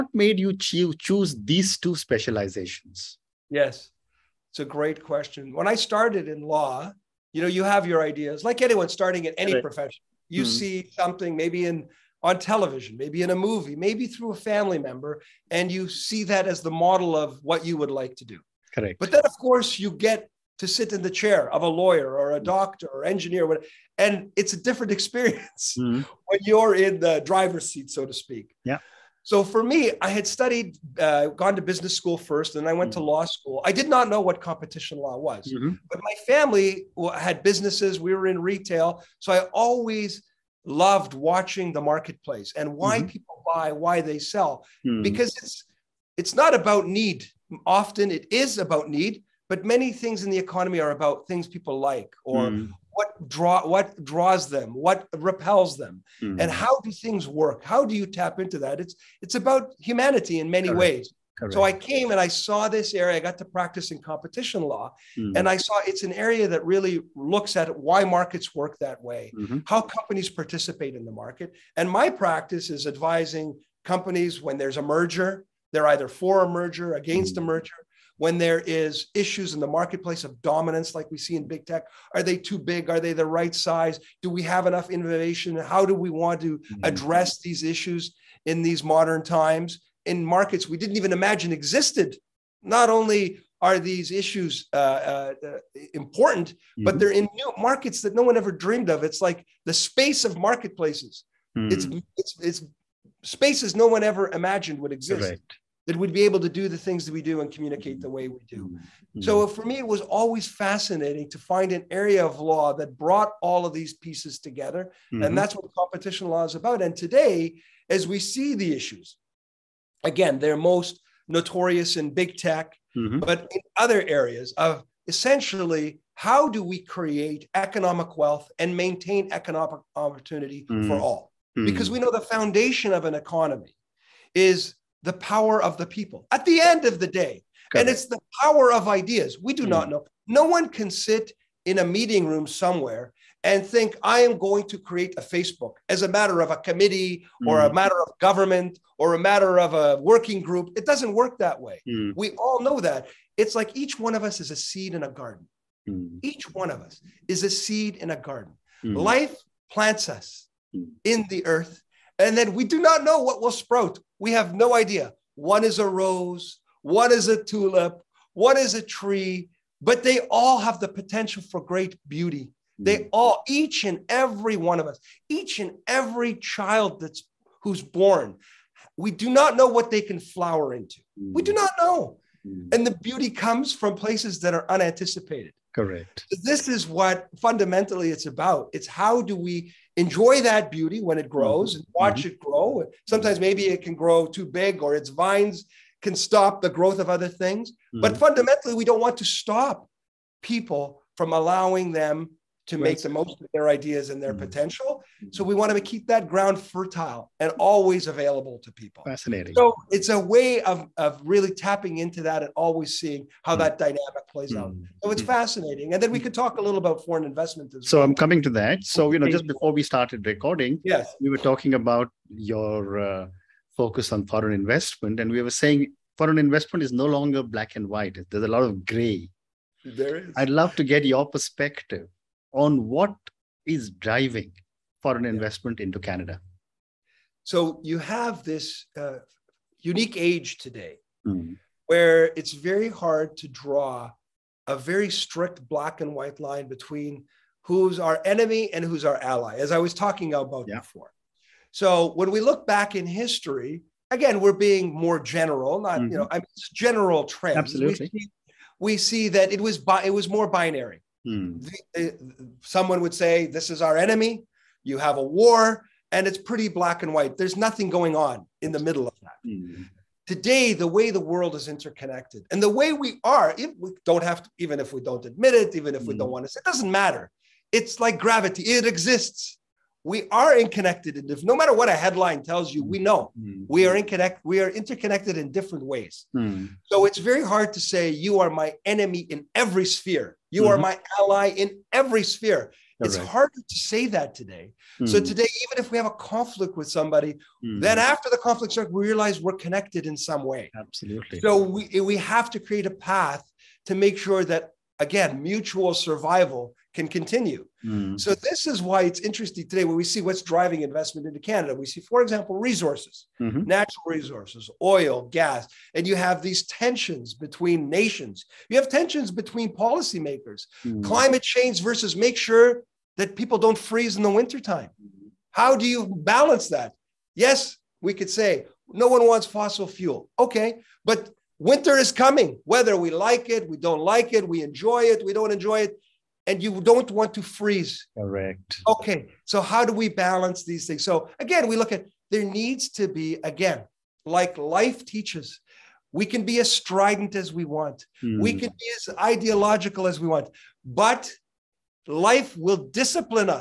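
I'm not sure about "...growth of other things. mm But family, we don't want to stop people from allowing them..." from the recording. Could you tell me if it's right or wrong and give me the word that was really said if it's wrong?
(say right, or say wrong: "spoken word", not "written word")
wrong: "fundamentally", not "family".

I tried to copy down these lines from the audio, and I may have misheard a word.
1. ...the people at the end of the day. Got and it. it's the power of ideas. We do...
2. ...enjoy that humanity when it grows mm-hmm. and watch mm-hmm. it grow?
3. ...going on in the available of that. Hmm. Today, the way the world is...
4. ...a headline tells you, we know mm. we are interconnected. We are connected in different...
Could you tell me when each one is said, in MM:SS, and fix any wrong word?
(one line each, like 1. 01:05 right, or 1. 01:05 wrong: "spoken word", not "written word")
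1. 02:15 right
2. 03:09 wrong: "beauty", not "humanity"
3. 04:27 wrong: "middle", not "available"
4. 04:41 wrong: "interconnected", not "connected".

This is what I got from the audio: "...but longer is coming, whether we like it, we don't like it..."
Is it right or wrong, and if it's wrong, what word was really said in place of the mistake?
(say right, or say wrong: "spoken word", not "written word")
wrong: "winter", not "longer".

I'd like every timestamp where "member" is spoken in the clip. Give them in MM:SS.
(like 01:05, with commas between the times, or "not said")
00:14.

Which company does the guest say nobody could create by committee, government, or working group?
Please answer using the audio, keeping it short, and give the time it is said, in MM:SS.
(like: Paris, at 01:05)
Facebook, at 02:25.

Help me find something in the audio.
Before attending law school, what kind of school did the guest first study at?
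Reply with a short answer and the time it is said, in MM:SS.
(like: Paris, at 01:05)
Business school, at 00:31.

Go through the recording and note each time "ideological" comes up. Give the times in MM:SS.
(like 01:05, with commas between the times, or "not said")
05:49.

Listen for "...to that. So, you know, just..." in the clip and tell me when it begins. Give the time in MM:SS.
03:38.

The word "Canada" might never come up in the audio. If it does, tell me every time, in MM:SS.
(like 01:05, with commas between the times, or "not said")
03:55, 05:11.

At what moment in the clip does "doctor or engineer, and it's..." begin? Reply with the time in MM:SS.
00:22.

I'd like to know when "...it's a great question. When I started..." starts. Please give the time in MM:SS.
00:04.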